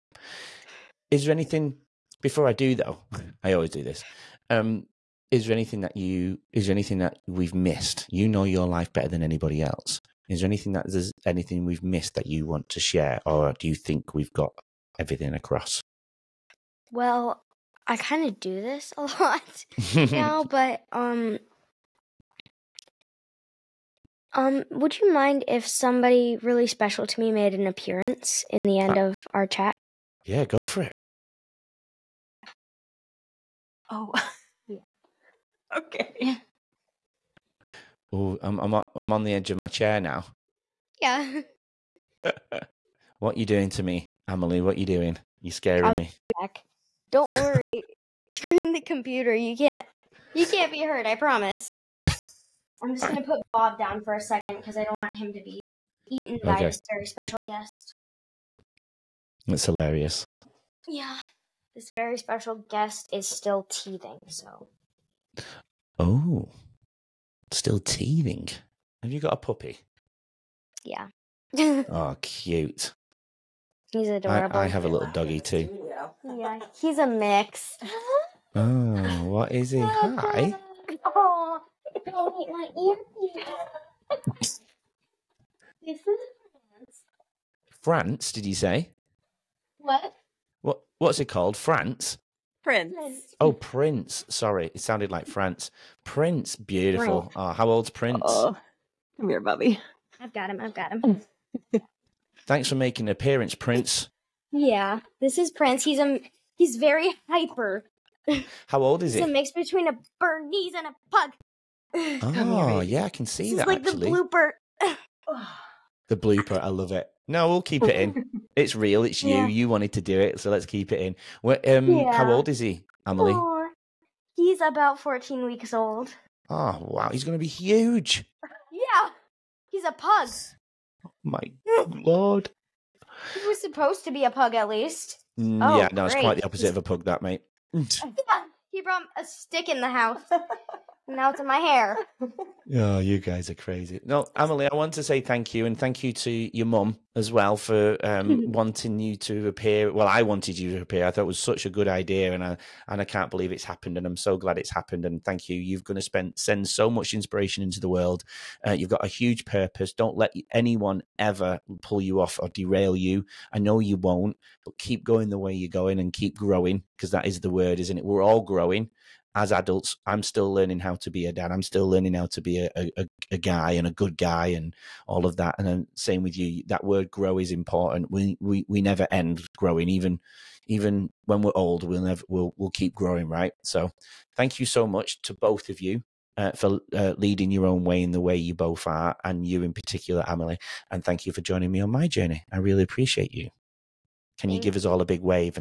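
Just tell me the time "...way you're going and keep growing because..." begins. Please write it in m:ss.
2:45.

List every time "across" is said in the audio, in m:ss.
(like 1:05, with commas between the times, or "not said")
0:15.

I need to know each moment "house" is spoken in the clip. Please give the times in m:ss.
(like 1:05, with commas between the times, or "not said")
2:19.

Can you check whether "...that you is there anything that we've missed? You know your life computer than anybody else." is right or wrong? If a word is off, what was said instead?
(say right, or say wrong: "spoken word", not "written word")
wrong: "better", not "computer".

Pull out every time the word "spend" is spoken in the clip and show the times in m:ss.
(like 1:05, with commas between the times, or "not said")
2:36.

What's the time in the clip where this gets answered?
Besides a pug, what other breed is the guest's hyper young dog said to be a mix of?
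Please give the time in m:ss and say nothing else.
1:50.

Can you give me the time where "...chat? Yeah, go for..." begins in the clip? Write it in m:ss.
0:29.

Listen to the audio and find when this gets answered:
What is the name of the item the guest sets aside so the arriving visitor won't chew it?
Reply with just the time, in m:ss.
0:53.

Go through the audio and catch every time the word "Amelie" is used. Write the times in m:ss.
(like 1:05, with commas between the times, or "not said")
0:44, 2:03, 2:24, 3:10.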